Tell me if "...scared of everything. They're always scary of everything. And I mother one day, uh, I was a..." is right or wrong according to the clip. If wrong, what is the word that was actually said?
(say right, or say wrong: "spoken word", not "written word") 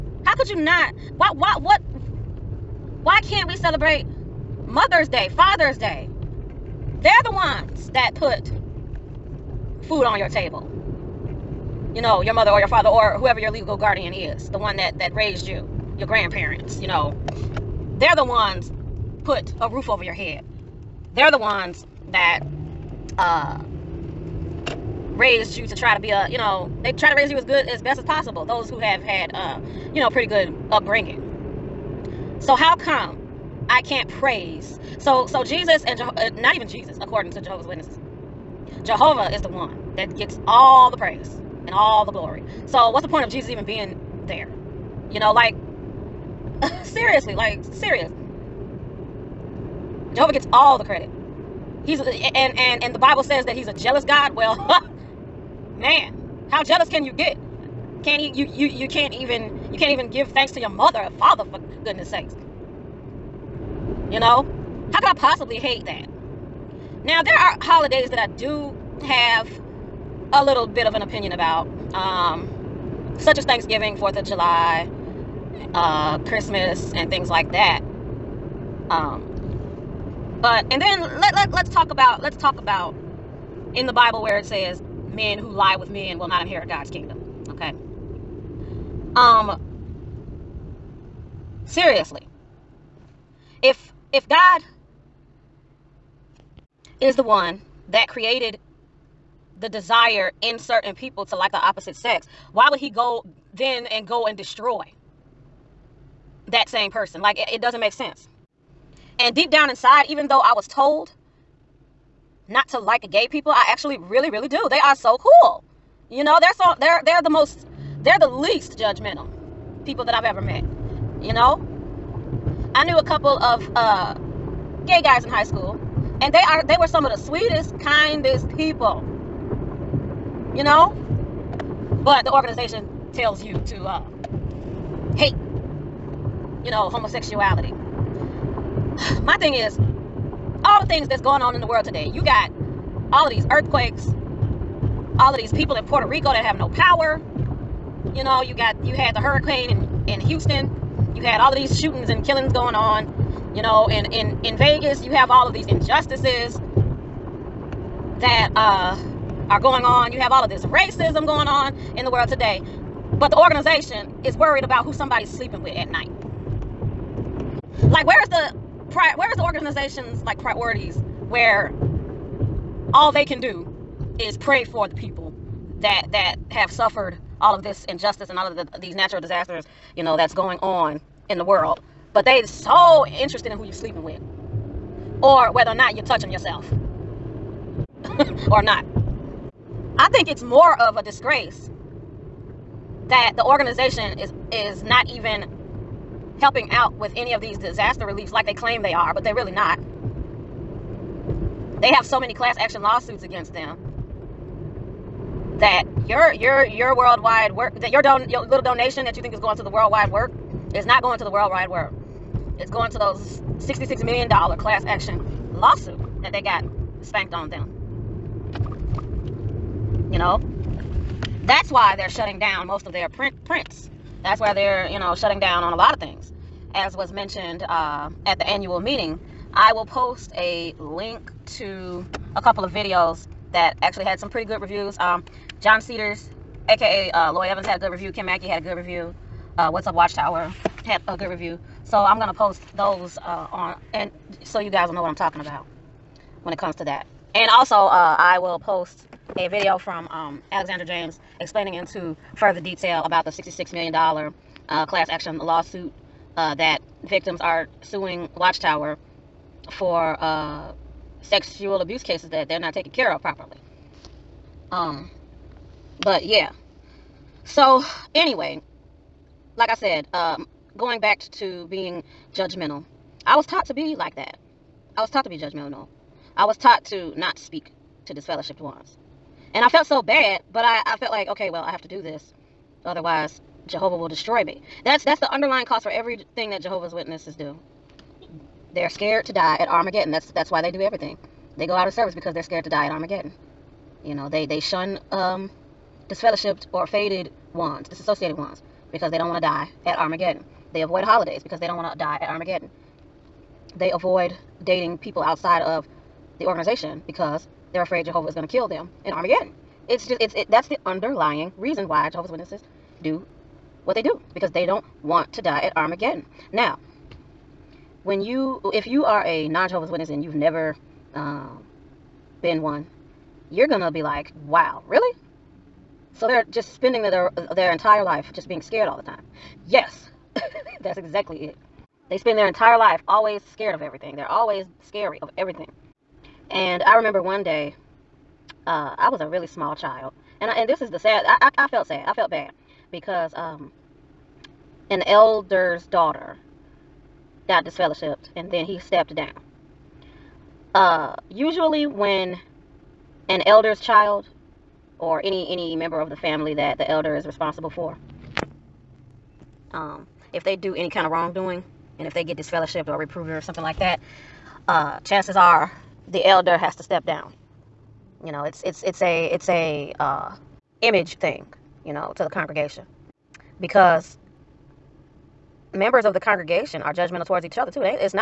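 wrong: "remember", not "mother".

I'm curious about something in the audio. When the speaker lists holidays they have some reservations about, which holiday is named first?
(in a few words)
Thanksgiving.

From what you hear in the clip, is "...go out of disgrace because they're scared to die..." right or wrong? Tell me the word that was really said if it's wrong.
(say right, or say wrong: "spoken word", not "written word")
wrong: "service", not "disgrace".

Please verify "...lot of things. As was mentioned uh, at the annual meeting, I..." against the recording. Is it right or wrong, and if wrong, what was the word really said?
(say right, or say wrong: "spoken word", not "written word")
right.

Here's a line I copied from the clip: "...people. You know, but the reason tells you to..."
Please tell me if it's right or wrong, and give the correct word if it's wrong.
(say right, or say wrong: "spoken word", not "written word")
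wrong: "organization", not "reason".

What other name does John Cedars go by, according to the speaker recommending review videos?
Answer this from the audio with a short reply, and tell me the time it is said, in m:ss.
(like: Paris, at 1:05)
Lloyd Evans, at 3:57.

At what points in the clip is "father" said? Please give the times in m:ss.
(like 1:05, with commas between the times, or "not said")
0:05, 0:12, 1:01.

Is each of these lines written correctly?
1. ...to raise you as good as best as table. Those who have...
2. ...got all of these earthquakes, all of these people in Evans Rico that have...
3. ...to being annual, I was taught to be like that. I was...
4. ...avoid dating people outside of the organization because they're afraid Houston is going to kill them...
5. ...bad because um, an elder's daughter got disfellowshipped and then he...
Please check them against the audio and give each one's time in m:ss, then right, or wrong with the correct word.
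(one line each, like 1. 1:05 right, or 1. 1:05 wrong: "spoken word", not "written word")
1. 0:27 wrong: "possible", not "table"
2. 2:22 wrong: "Puerto", not "Evans"
3. 4:31 wrong: "judgmental", not "annual"
4. 5:03 wrong: "Jehovah", not "Houston"
5. 5:42 right.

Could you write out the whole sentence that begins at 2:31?
You had all of these shootings and killings going on.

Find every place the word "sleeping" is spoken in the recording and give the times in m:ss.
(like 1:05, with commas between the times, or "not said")
2:45, 3:03.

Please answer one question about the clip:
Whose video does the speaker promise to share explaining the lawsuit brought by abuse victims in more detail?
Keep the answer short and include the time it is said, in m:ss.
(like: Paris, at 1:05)
Alexander James, at 4:10.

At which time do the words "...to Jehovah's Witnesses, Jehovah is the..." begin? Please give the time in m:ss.
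0:37.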